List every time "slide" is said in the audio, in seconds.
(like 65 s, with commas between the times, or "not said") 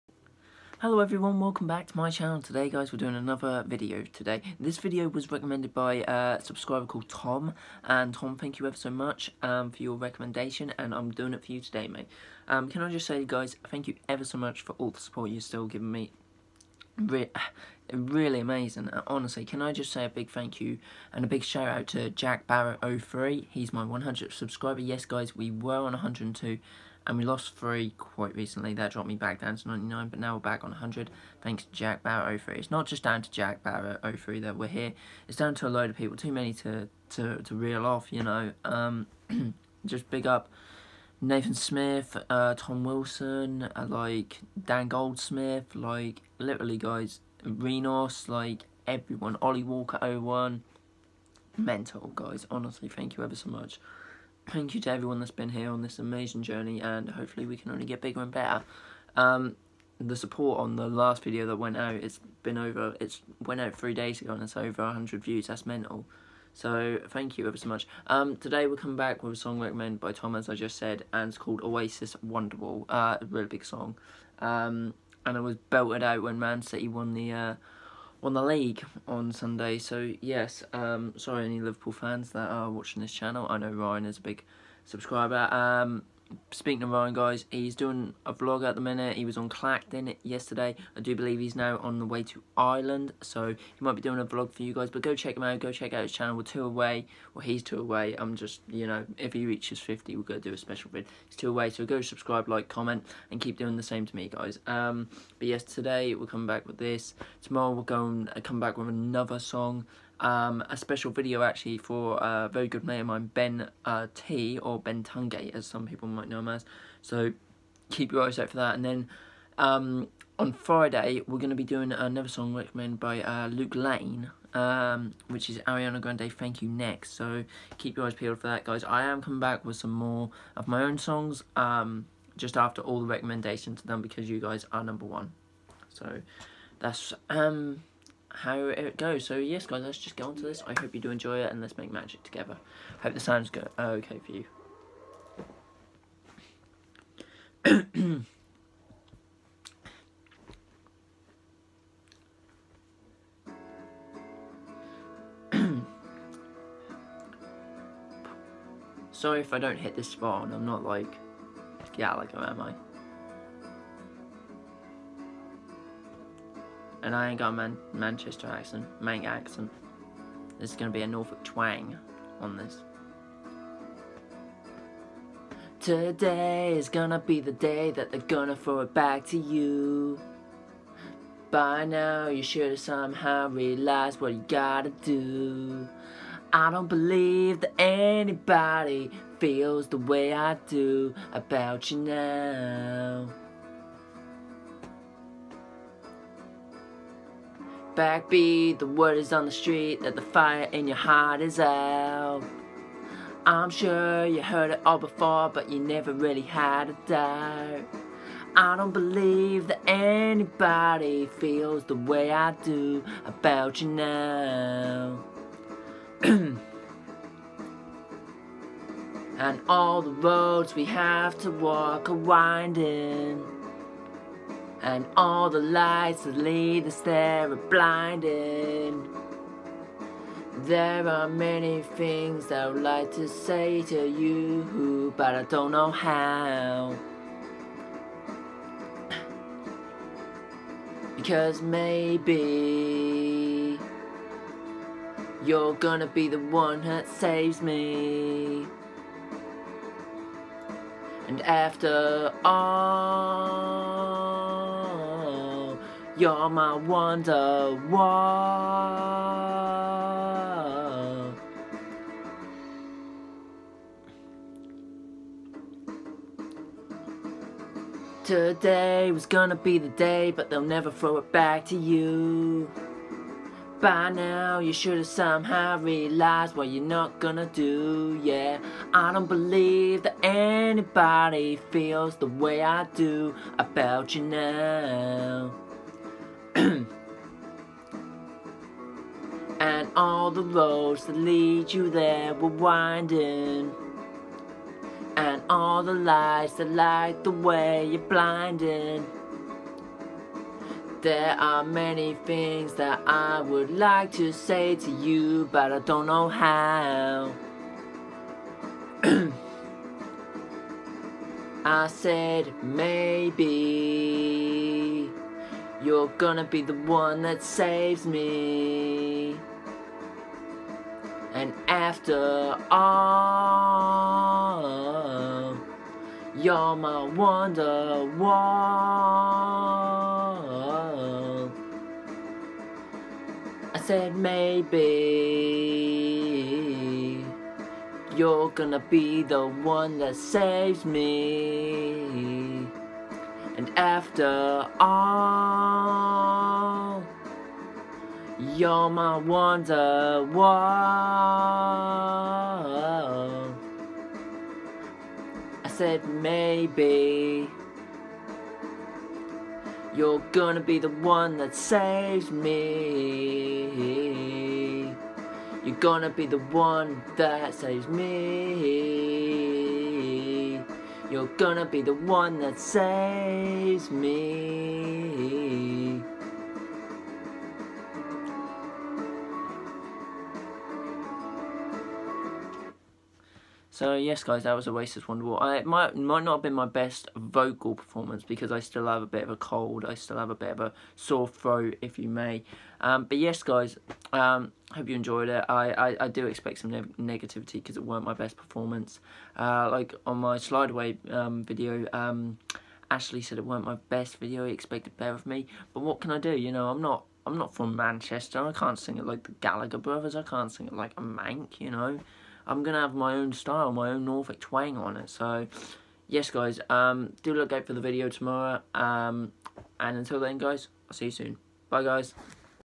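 400 s.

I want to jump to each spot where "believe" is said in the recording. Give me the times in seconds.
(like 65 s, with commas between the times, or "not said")
91 s, 186 s, 208 s, 279 s.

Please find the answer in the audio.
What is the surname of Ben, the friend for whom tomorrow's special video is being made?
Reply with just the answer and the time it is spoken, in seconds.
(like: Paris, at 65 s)
Tungate, at 115 s.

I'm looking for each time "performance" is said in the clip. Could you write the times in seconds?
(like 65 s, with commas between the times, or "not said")
387 s, 398 s.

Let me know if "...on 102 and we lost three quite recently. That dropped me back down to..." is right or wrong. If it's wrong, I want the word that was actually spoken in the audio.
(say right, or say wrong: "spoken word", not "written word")
right.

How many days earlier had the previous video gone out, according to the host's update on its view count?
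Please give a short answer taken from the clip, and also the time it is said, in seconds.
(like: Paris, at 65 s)
3, at 63 s.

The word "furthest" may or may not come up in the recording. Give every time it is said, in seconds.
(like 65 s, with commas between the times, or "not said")
not said.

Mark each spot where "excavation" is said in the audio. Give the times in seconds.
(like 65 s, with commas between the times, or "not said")
not said.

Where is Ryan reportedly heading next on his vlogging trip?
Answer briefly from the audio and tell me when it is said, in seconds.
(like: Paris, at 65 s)
Ireland, at 92 s.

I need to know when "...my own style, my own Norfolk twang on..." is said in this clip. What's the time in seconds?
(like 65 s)
412 s.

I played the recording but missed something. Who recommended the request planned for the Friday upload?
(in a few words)
Luke Lane.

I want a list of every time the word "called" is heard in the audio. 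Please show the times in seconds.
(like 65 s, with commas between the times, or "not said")
6 s, 71 s.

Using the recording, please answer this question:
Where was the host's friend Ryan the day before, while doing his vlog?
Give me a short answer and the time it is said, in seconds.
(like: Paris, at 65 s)
Clacton, at 89 s.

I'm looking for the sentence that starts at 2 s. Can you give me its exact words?
Today guys, we're doing another video today.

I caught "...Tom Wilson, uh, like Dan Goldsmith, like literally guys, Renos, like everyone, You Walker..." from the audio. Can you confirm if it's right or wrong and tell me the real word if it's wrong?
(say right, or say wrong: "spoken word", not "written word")
wrong: "Ollie", not "You".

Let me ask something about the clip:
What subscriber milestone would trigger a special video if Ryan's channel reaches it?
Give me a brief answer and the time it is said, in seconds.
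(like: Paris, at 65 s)
50, at 99 s.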